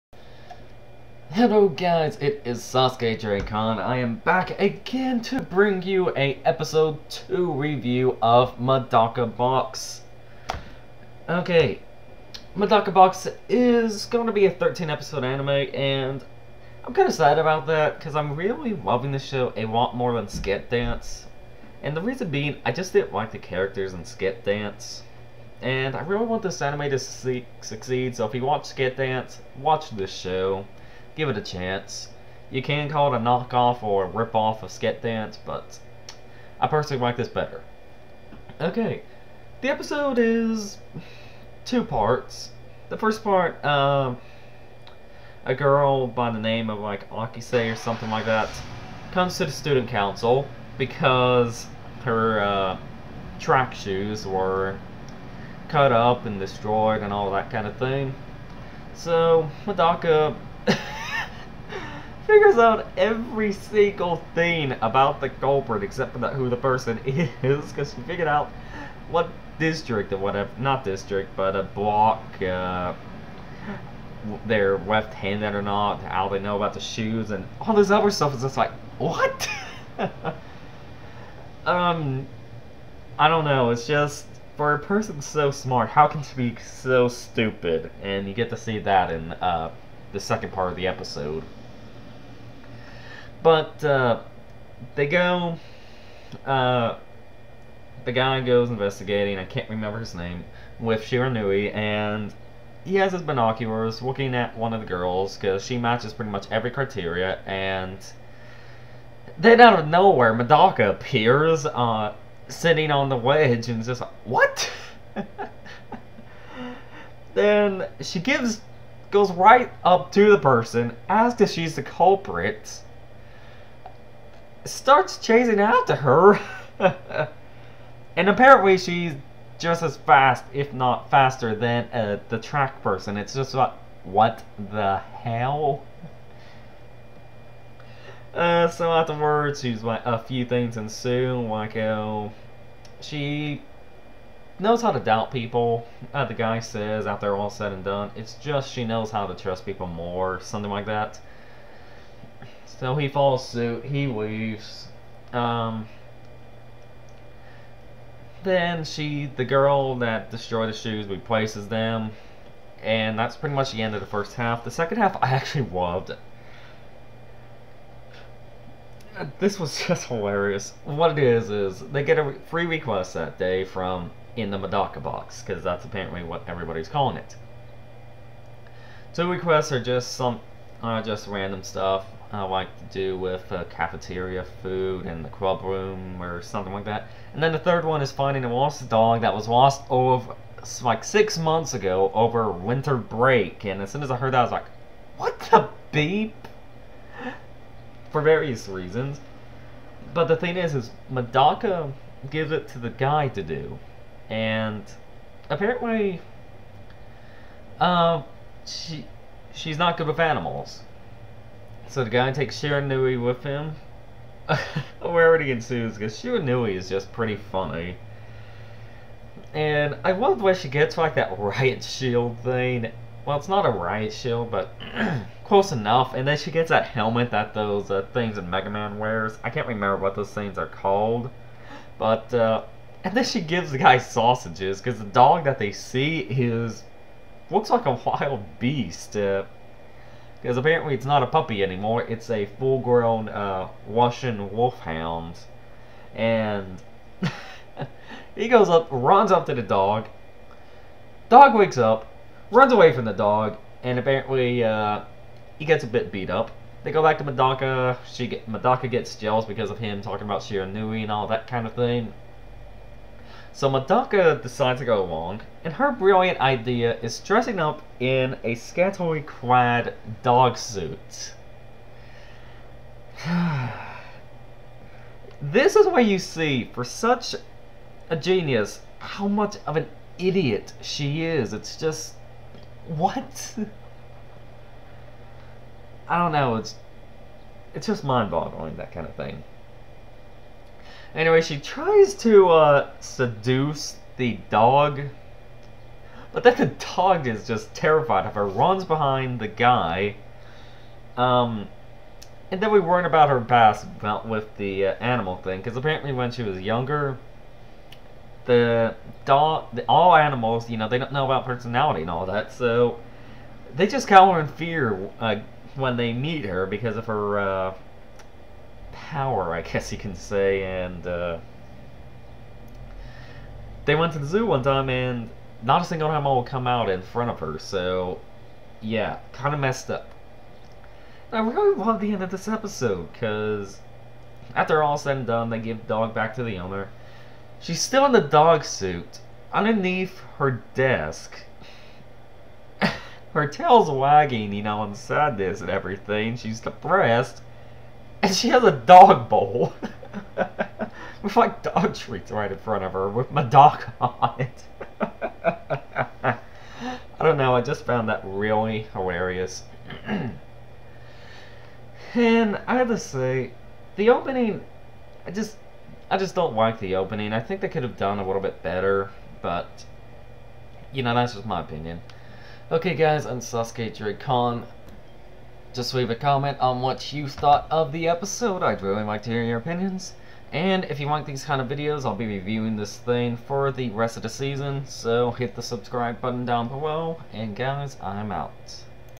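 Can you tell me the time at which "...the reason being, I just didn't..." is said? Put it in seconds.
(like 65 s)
21 s.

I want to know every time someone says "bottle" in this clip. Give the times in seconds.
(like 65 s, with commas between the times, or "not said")
not said.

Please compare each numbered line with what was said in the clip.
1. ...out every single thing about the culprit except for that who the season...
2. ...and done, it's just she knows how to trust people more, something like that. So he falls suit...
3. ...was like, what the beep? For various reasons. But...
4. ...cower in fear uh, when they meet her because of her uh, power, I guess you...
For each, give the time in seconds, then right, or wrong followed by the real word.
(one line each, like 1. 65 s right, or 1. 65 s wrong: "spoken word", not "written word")
1. 62 s wrong: "person", not "season"
2. 147 s right
3. 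194 s right
4. 314 s right.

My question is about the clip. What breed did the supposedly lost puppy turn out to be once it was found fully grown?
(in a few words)
Russian wolfhound.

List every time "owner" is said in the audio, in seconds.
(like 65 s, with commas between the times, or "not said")
336 s.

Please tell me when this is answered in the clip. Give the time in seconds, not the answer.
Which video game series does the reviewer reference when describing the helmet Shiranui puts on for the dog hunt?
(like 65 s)
228 s.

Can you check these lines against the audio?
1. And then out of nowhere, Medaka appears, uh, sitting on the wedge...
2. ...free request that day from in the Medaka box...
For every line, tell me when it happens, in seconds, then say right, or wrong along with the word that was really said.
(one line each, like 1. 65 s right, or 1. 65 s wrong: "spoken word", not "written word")
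1. 107 s right
2. 172 s right.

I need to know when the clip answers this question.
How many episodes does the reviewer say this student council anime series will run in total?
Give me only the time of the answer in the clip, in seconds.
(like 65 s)
14 s.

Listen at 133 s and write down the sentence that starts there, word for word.
It's just like, what the hell?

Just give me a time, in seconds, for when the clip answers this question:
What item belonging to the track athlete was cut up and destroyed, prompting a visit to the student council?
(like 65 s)
53 s.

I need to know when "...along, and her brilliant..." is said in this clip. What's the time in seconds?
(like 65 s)
265 s.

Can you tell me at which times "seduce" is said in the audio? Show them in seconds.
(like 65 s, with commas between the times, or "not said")
293 s.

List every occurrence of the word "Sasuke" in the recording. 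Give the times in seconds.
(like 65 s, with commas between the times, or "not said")
2 s, 373 s.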